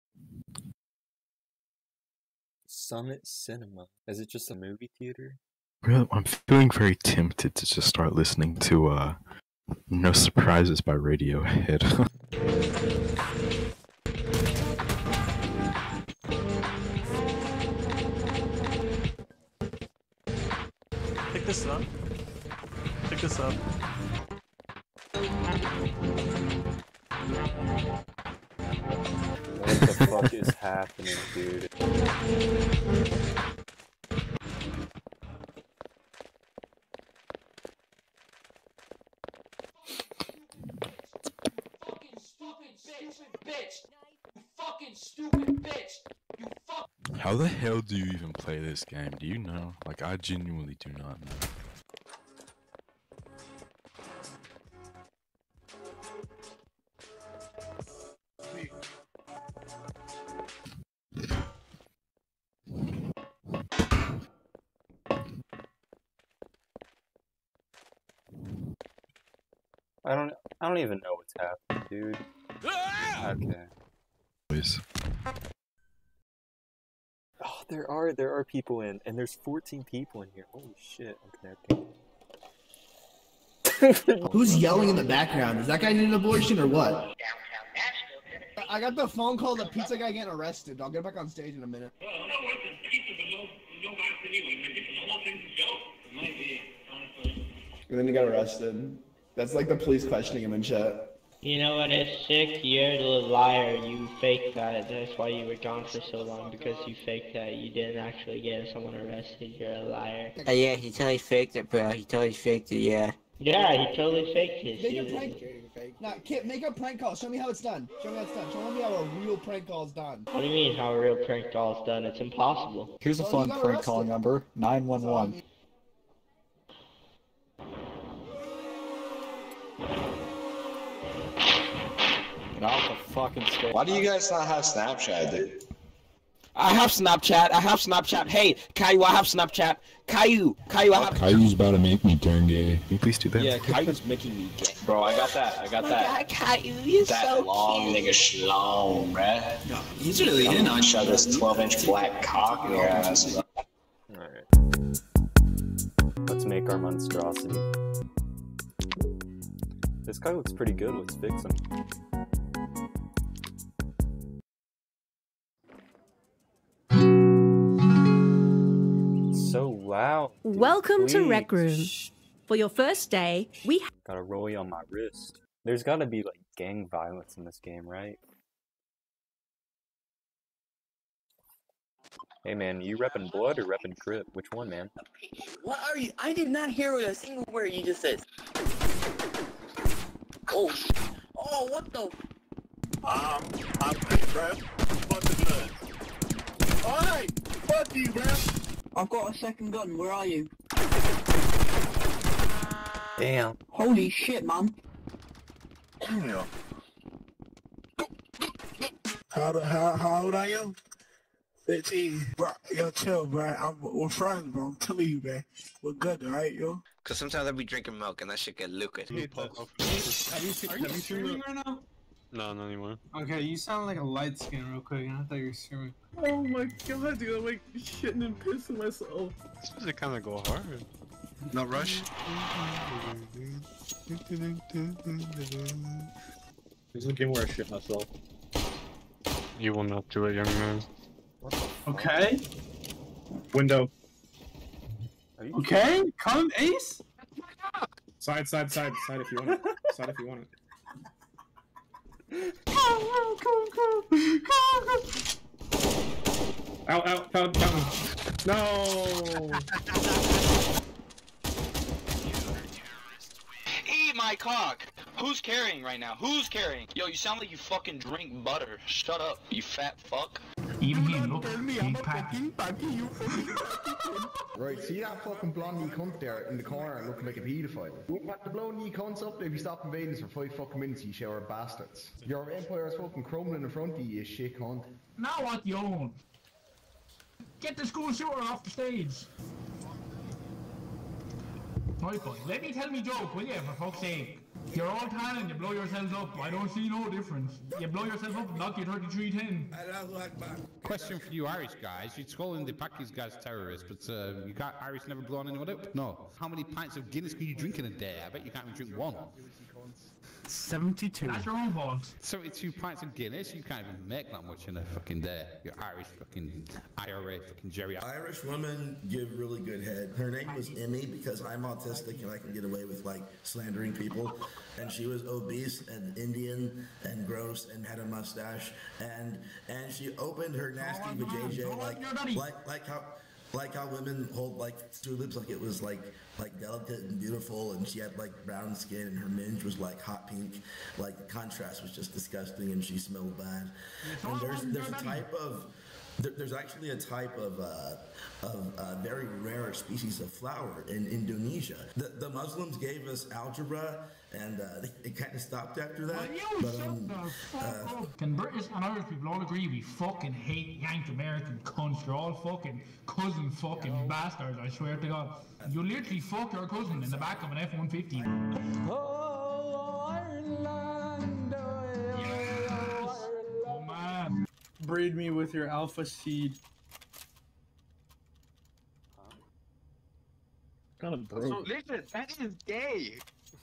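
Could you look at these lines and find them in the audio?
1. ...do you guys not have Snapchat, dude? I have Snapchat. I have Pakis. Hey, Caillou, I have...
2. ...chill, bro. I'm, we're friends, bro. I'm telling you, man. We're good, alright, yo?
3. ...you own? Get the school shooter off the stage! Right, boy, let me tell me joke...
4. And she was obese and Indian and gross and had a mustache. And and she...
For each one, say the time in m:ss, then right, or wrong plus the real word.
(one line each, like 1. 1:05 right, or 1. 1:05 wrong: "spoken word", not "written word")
1. 2:13 wrong: "Snapchat", not "Pakis"
2. 3:32 right
3. 4:45 right
4. 5:24 right.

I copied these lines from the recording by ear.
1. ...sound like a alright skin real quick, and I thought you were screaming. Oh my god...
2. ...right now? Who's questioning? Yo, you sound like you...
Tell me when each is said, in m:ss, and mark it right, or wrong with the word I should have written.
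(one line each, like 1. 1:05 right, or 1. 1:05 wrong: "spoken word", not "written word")
1. 3:43 wrong: "light", not "alright"
2. 4:25 wrong: "carrying", not "questioning".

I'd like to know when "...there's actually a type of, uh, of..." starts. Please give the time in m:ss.
5:46.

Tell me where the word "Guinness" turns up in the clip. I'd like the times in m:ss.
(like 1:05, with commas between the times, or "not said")
5:07, 5:13.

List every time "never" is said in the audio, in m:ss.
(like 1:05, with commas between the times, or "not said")
5:05.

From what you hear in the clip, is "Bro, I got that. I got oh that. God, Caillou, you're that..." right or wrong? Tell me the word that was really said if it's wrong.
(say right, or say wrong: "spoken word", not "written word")
right.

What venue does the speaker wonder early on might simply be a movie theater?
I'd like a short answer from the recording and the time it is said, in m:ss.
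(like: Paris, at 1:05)
Summit Cinema, at 0:02.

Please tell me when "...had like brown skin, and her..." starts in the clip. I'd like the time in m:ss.
5:37.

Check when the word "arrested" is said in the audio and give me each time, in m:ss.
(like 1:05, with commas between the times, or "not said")
1:30, 1:38, 1:48.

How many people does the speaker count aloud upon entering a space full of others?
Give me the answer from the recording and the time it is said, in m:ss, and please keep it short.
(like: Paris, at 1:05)
14, at 1:19.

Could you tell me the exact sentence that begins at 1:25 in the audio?
Is that guy need an abortion or what?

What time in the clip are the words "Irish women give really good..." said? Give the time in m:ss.
5:17.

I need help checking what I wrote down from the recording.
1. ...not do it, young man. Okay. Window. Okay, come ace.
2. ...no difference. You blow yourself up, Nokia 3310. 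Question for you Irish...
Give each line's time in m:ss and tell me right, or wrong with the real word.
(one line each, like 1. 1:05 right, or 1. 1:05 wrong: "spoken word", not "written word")
1. 3:59 right
2. 4:56 right.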